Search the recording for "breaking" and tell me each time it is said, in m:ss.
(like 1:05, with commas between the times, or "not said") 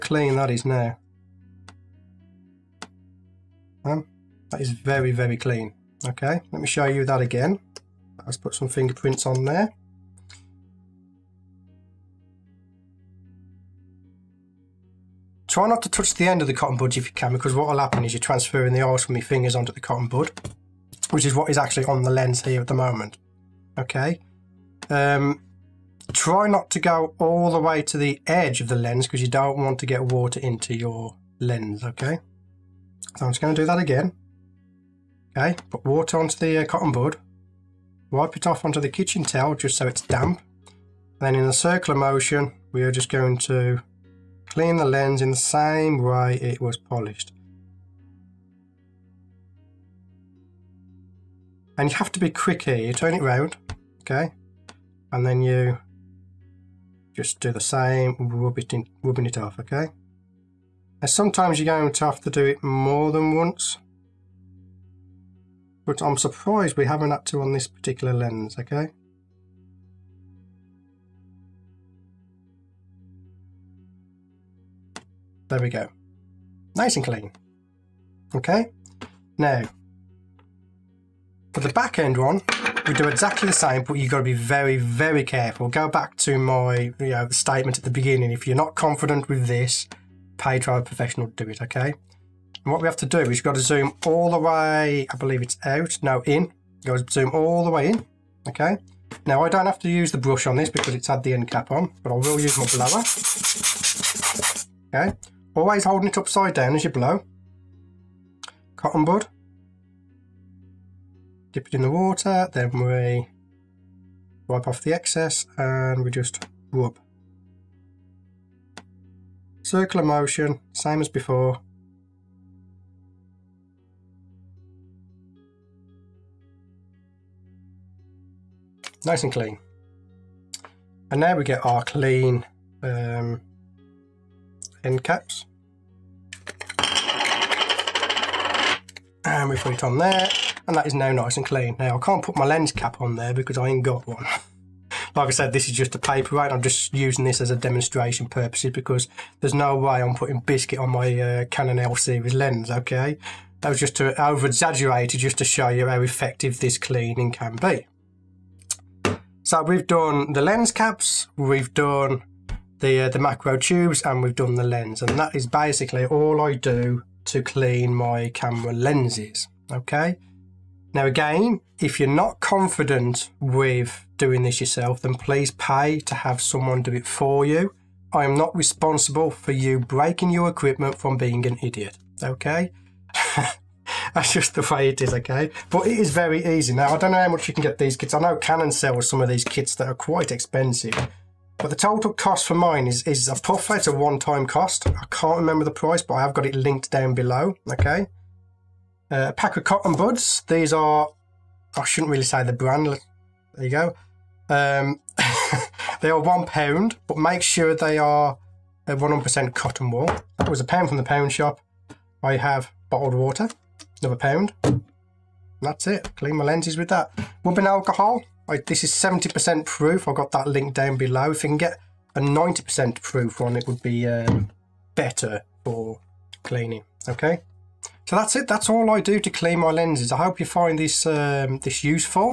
2:59.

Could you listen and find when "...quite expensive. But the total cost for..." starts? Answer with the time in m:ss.
3:09.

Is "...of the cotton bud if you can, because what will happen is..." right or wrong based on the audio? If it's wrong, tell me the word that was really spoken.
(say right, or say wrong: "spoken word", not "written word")
right.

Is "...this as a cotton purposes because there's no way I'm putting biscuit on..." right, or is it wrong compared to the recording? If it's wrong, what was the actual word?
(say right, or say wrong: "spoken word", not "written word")
wrong: "demonstration", not "cotton".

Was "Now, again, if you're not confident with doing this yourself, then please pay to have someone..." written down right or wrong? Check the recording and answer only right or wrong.
right.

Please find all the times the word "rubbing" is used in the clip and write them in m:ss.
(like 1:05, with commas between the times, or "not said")
0:59, 3:37.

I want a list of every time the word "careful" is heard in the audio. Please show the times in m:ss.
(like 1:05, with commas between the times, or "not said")
1:25.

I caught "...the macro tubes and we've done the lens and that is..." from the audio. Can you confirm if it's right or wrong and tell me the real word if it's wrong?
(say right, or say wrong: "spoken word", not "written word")
right.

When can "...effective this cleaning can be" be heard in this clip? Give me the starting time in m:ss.
2:36.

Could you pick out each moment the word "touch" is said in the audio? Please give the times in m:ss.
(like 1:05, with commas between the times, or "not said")
0:15.